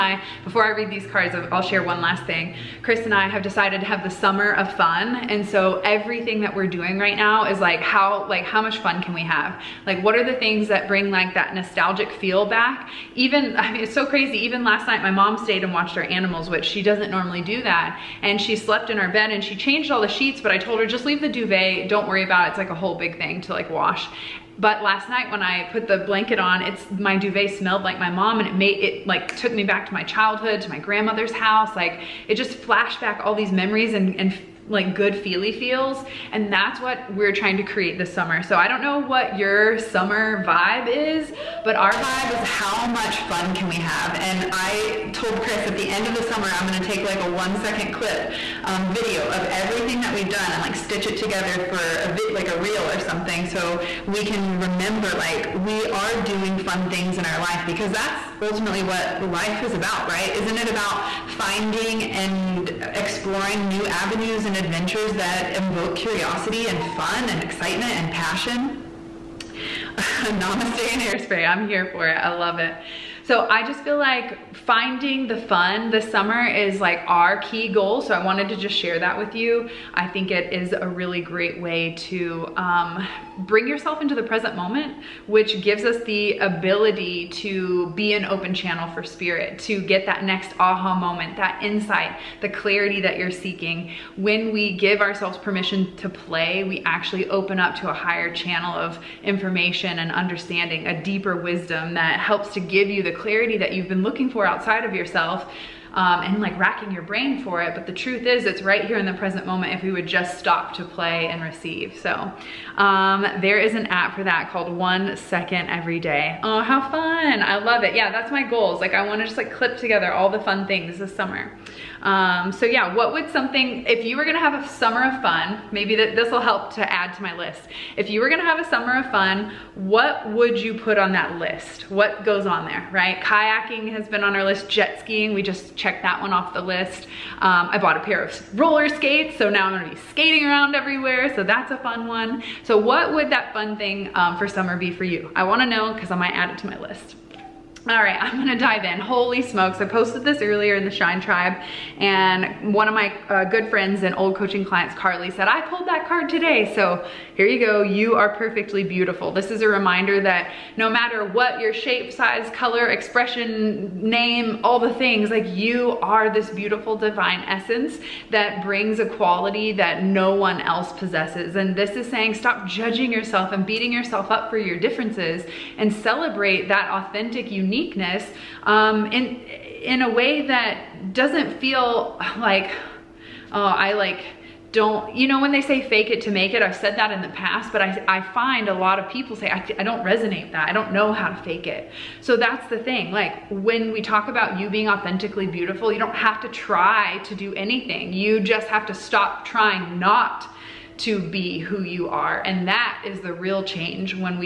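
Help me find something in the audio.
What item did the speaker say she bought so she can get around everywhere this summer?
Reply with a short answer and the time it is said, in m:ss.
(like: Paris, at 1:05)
roller skates, at 2:18.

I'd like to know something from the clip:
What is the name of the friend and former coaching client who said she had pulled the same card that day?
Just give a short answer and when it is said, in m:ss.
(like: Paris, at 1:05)
Carly, at 2:34.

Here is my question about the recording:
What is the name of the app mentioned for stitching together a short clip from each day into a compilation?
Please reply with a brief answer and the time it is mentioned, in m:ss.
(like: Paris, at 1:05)
One Second Every Day, at 1:54.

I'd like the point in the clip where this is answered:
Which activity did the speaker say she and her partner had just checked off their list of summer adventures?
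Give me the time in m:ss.
2:14.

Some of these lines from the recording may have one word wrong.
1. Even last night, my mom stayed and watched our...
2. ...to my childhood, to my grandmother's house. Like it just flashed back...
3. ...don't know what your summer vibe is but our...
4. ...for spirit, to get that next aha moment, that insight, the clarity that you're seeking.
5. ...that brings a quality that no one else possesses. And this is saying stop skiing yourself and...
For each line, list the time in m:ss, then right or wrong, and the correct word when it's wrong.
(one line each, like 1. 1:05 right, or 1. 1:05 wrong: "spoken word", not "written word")
1. 0:14 right
2. 0:29 right
3. 0:38 right
4. 1:28 right
5. 2:48 wrong: "judging", not "skiing".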